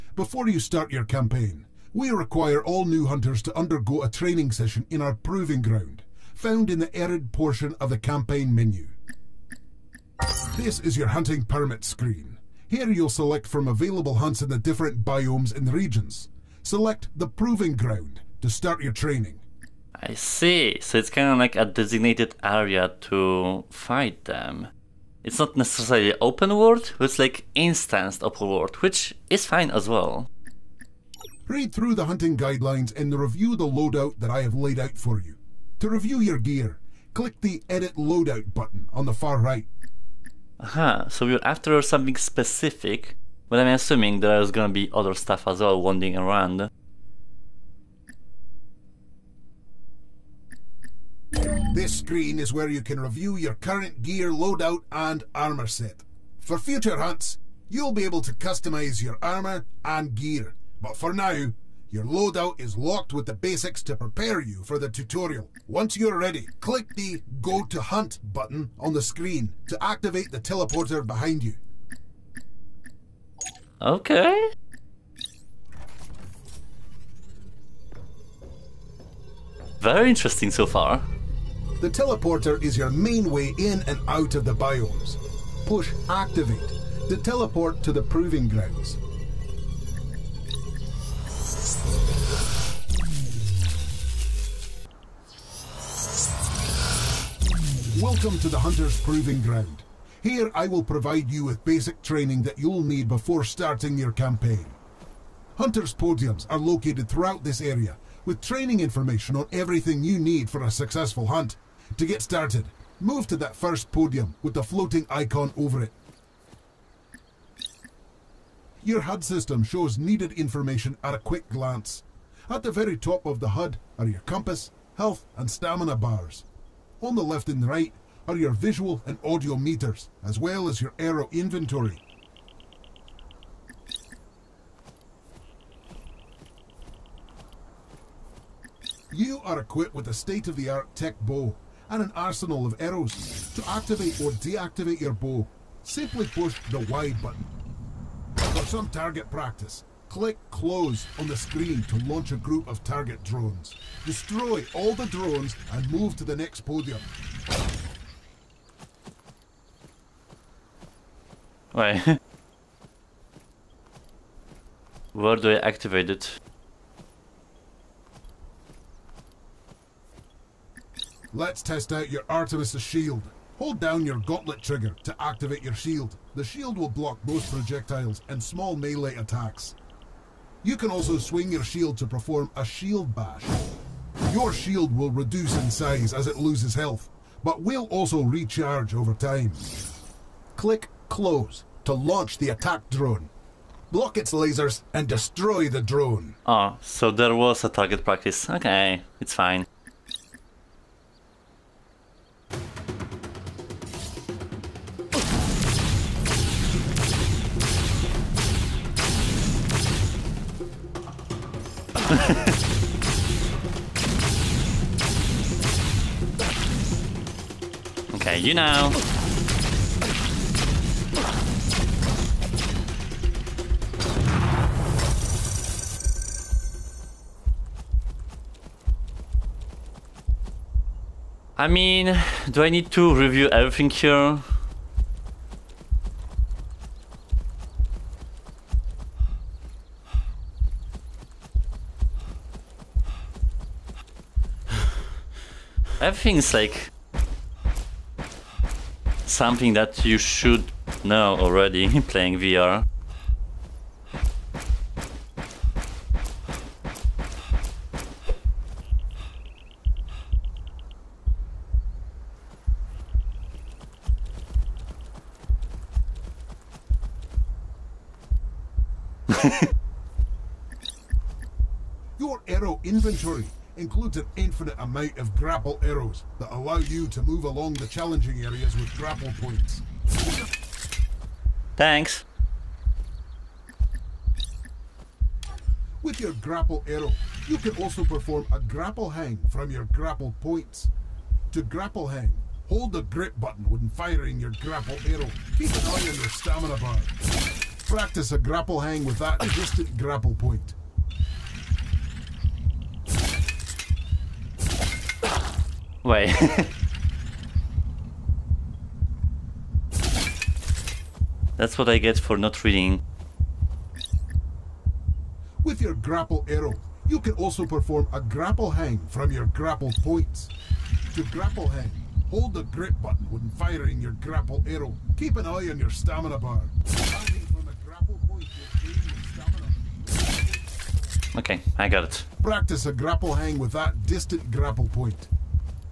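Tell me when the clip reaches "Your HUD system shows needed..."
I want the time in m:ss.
1:58.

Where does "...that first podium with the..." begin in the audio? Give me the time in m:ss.
1:53.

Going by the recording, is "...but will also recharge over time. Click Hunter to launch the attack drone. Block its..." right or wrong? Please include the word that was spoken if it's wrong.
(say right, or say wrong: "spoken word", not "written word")
wrong: "Close", not "Hunter".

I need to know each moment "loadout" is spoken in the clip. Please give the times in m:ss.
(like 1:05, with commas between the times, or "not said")
0:33, 0:37, 0:54, 1:02.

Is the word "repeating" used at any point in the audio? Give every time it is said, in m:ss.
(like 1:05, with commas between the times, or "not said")
not said.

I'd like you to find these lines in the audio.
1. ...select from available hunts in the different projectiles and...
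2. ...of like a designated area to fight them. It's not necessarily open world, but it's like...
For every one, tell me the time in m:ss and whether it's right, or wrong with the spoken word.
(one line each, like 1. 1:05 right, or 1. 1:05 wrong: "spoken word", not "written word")
1. 0:13 wrong: "biomes", not "projectiles"
2. 0:21 right.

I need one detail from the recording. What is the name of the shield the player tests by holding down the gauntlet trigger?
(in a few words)
Artemis' shield.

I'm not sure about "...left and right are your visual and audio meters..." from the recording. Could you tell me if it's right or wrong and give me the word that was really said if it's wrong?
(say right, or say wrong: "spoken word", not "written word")
right.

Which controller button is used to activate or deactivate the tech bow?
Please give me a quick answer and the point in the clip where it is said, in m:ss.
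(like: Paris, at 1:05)
Y button, at 2:26.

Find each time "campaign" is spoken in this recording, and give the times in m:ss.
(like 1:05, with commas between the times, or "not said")
0:01, 0:07, 1:44.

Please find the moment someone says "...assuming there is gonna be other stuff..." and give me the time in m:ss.
0:43.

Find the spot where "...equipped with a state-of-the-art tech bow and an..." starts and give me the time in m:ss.
2:19.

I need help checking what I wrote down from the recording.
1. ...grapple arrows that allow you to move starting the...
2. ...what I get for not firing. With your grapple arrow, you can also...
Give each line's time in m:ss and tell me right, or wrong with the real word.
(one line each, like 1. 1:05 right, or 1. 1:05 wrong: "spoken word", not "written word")
1. 4:35 wrong: "along", not "starting"
2. 5:11 wrong: "reading", not "firing".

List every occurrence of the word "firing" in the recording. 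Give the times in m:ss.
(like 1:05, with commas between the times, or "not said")
4:53, 5:23.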